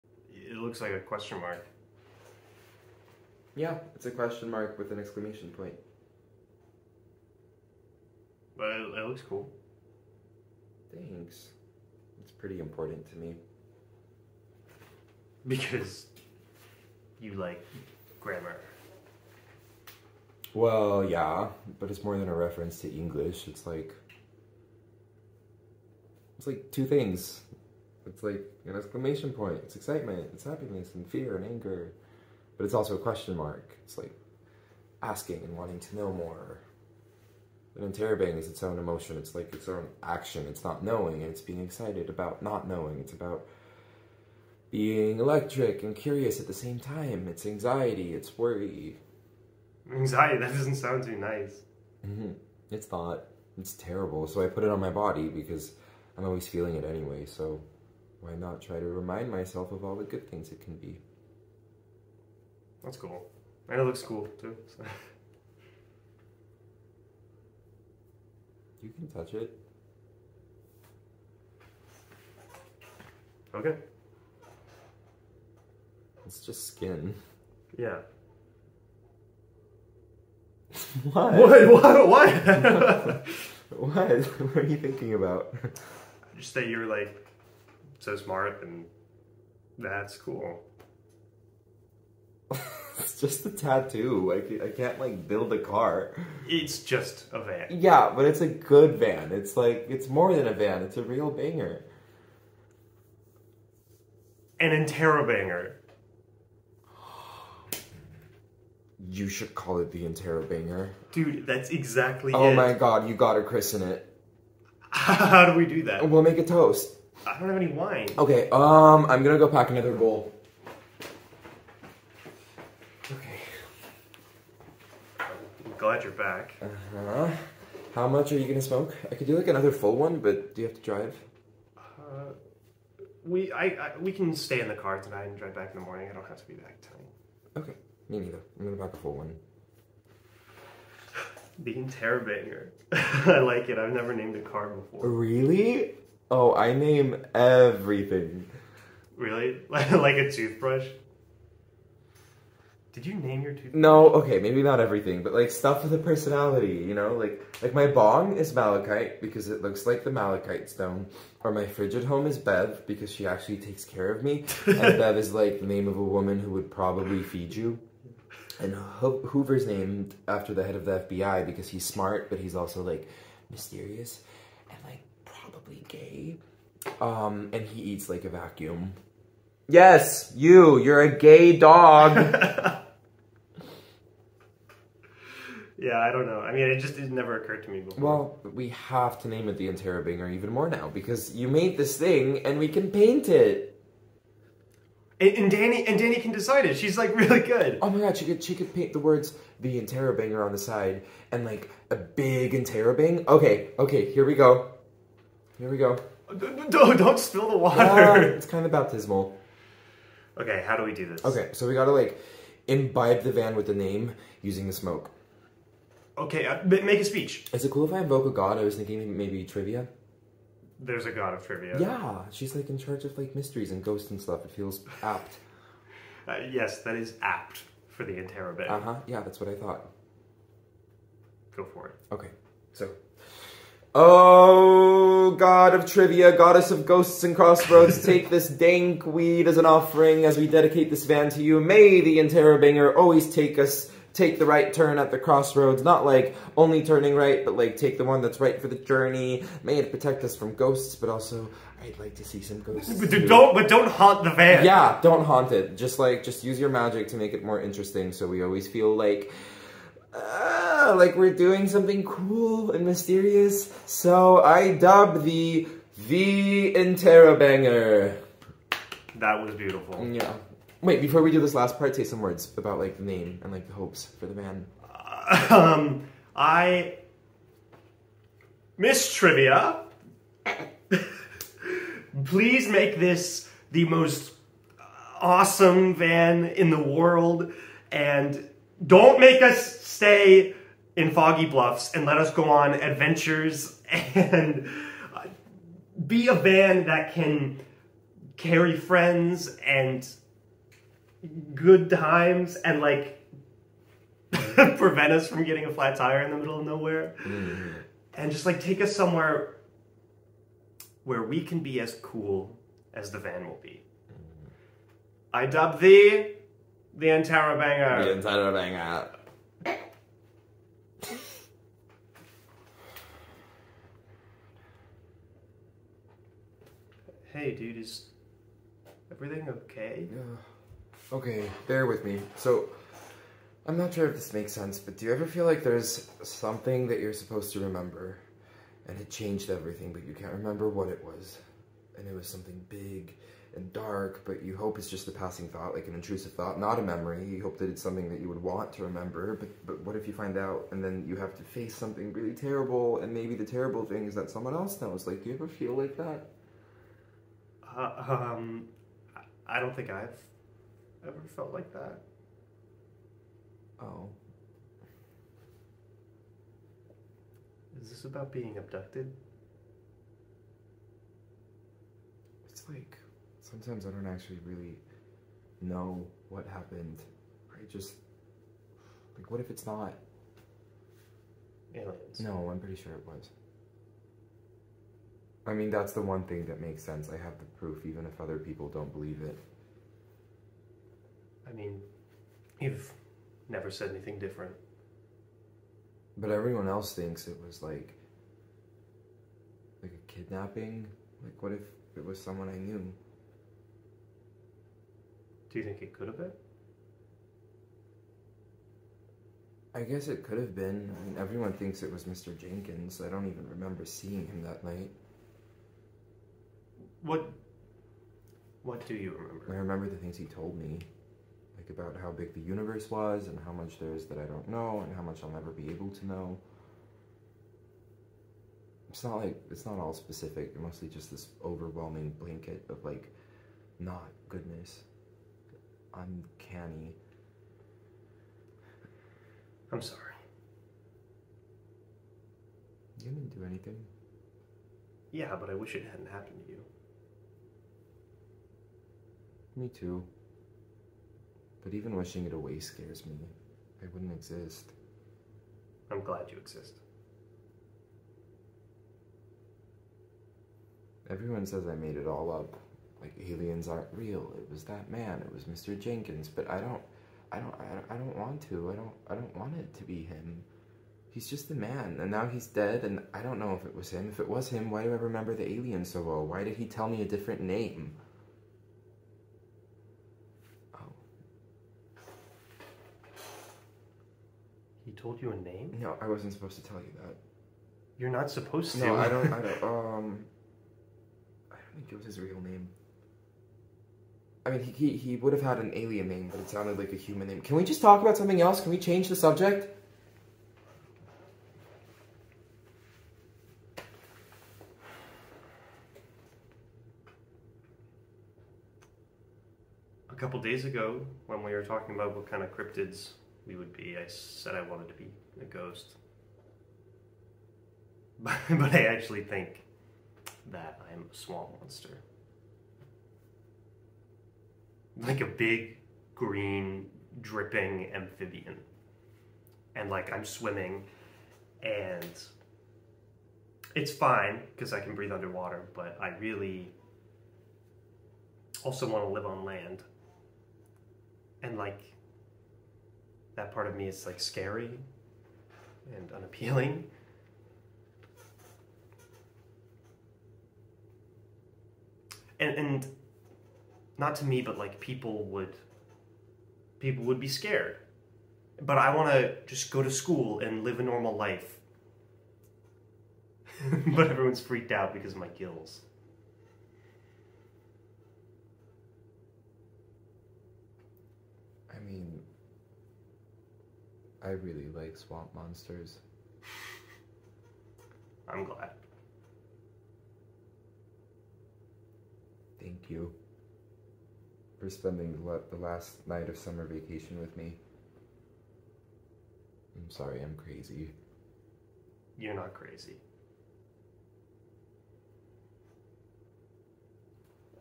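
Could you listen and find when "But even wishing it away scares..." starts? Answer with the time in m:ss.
7:31.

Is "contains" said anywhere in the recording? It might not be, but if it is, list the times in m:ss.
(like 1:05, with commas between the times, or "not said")
not said.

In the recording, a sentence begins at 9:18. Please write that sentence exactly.
But I want to just go to school and live a normal life.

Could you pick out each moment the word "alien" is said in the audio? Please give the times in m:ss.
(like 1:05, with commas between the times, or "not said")
6:21, 7:43, 7:55, 8:15.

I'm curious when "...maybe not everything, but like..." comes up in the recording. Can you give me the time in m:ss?
2:34.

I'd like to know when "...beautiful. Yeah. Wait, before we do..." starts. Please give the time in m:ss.
4:29.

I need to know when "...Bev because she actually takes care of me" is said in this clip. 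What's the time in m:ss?
2:42.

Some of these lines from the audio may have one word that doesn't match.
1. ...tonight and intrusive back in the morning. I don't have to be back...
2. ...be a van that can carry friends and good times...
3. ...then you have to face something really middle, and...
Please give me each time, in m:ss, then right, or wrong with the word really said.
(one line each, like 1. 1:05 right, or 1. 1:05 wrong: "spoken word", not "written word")
1. 2:15 wrong: "drive", not "intrusive"
2. 4:56 right
3. 5:50 wrong: "terrible", not "middle".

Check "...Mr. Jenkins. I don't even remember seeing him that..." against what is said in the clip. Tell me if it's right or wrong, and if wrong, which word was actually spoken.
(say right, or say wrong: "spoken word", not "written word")
right.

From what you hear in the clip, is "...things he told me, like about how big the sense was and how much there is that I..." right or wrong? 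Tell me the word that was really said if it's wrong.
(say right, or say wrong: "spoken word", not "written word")
wrong: "universe", not "sense".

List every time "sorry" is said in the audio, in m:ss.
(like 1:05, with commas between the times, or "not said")
7:19, 9:49.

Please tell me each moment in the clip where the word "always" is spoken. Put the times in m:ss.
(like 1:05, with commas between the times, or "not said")
0:56, 4:02, 4:18.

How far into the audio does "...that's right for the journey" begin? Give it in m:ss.
4:08.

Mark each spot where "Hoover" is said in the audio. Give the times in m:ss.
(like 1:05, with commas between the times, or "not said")
2:49.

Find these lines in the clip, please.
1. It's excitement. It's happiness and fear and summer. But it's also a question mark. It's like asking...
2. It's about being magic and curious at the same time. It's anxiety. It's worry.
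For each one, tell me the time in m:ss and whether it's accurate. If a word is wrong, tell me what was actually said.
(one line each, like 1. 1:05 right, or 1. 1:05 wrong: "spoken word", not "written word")
1. 0:29 wrong: "anger", not "summer"
2. 0:42 wrong: "electric", not "magic".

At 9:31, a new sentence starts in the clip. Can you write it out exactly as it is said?
I mean, I really like swamp monsters.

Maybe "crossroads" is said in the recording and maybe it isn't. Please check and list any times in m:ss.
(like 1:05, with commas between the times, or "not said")
3:57, 4:05.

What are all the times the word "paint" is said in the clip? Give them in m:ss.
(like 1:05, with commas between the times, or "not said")
3:12, 3:18.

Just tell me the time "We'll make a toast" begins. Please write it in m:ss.
1:56.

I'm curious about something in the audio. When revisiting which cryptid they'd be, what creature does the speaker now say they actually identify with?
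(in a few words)
Swamp monster.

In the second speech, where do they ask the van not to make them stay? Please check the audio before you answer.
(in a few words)
Foggy Bluffs.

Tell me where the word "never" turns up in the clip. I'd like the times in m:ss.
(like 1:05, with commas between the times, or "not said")
2:23, 3:07, 6:33, 7:05.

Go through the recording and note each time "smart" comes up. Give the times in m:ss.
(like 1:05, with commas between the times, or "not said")
1:28, 2:51.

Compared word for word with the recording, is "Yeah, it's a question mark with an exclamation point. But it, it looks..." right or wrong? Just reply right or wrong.
right.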